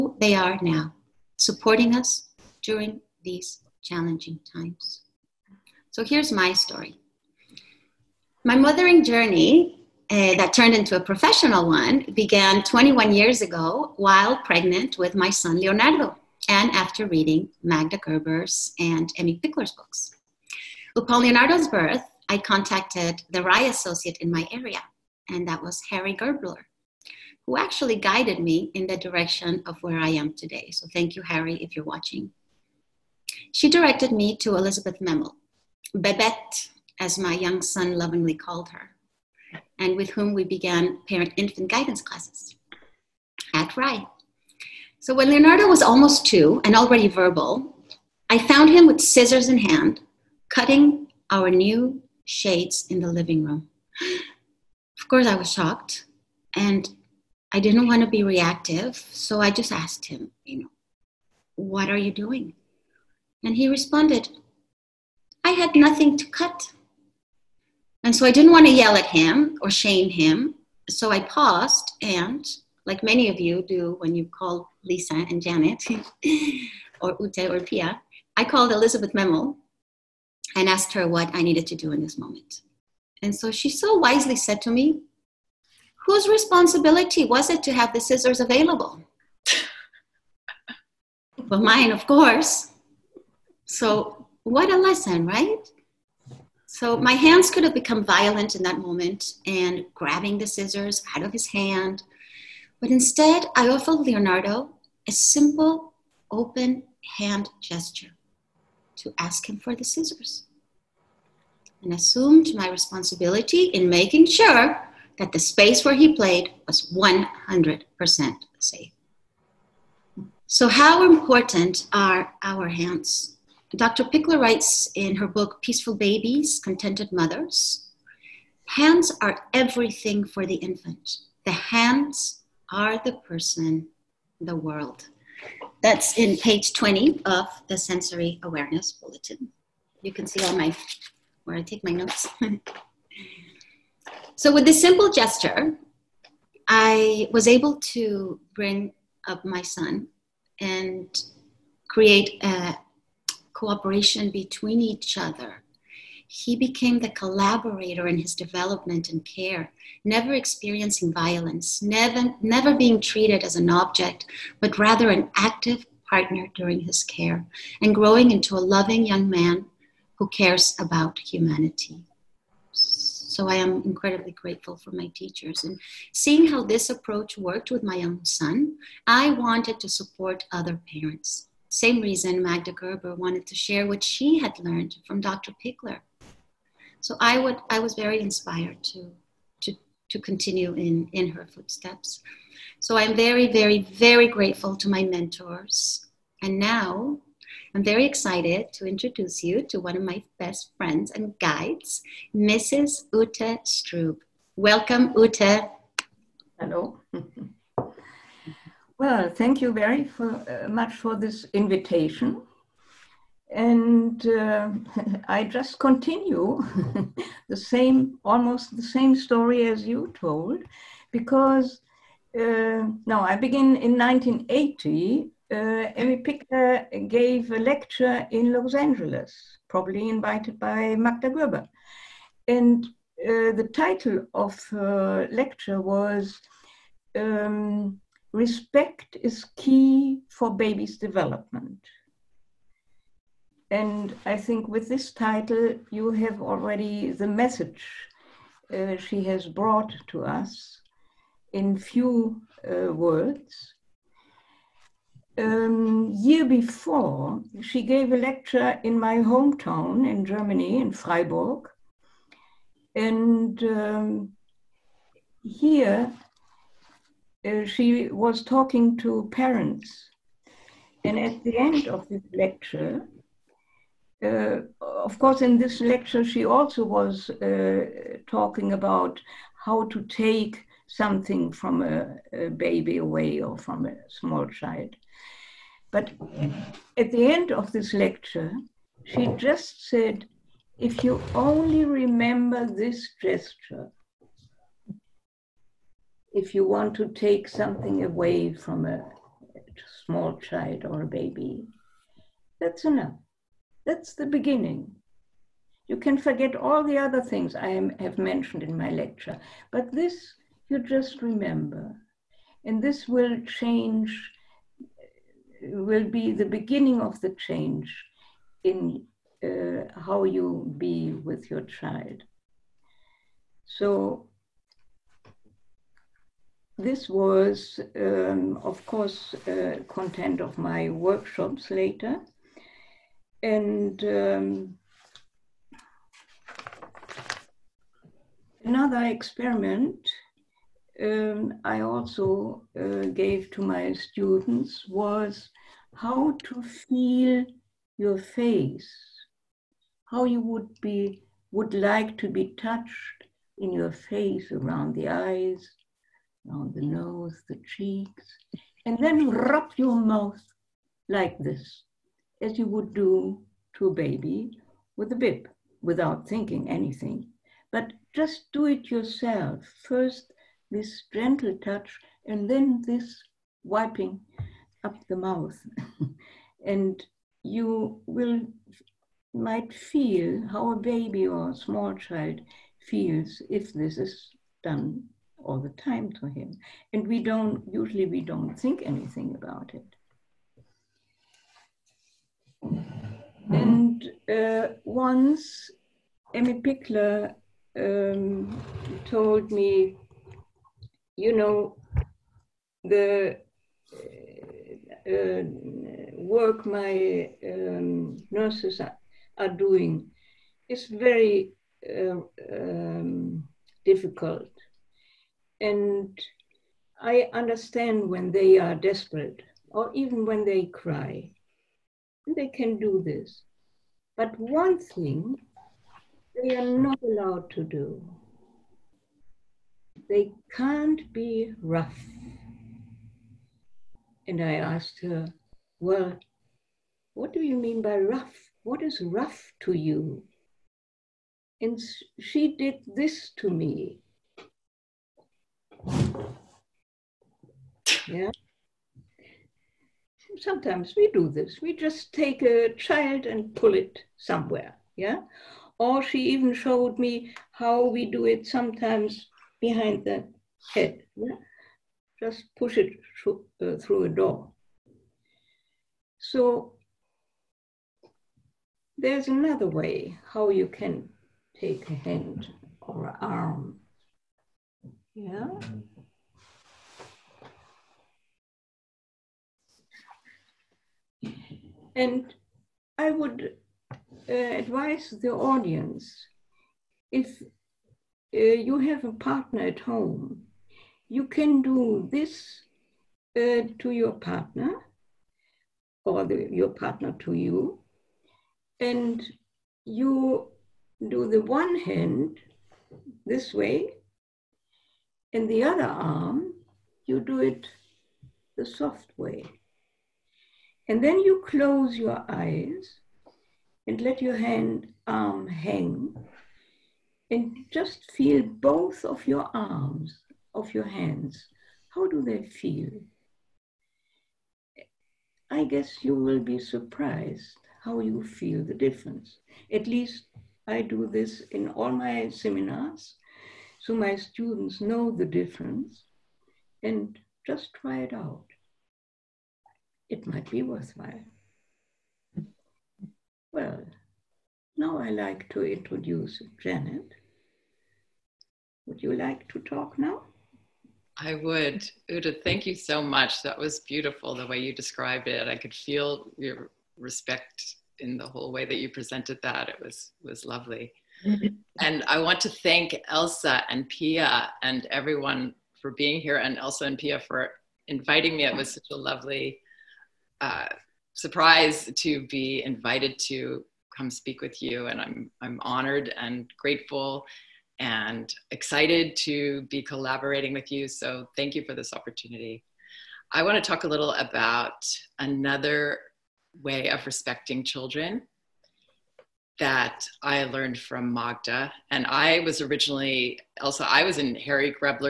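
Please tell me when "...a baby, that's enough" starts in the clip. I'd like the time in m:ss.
5:01.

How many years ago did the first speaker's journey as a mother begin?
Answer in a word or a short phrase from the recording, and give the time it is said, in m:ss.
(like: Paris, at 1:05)
21, at 0:12.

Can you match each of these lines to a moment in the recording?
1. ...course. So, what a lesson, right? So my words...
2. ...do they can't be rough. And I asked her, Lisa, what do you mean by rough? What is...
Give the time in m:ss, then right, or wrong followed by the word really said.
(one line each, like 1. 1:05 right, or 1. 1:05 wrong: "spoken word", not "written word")
1. 1:32 wrong: "hands", not "words"
2. 7:07 wrong: "Well", not "Lisa".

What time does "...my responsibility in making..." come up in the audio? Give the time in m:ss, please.
1:52.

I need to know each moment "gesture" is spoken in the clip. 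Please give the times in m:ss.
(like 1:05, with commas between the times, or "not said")
1:47, 2:25, 4:53.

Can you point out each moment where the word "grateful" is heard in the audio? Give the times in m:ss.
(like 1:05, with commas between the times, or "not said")
2:54, 3:14, 9:36.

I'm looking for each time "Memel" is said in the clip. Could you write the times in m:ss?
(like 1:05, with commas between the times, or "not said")
0:35, 1:19.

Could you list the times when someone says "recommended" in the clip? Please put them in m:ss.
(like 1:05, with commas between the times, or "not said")
not said.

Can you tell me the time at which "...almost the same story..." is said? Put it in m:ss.
3:38.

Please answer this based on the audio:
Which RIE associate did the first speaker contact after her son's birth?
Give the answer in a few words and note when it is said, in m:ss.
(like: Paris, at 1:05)
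Harry Grebler, at 0:25.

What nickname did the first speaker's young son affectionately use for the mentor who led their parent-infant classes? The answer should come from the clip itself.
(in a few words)
Babette.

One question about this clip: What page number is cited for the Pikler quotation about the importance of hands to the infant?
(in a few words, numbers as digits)
20.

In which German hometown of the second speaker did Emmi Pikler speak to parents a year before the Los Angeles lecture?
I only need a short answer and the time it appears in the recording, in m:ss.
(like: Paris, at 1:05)
Freiburg, at 4:20.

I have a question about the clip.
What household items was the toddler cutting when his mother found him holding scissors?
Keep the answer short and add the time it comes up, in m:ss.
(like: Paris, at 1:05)
shades, at 0:52.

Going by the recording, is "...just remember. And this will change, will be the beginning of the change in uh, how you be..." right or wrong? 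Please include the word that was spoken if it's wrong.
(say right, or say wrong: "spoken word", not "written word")
right.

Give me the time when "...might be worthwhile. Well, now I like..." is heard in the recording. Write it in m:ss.
9:00.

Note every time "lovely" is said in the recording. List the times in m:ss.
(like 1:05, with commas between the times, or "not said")
9:20, 9:28.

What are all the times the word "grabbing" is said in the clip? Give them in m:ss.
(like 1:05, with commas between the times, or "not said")
1:39.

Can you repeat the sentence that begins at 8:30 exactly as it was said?
And then you close your eyes and let your hand arm hang and just feel both of your arms, of your hands.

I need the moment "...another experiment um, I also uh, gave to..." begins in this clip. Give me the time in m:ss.
5:38.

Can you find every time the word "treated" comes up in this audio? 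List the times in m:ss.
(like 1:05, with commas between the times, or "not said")
2:43.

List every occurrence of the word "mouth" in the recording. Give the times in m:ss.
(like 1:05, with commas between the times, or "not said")
5:59, 6:15.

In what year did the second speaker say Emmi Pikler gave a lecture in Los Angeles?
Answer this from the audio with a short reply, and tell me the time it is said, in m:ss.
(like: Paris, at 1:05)
1980, at 3:43.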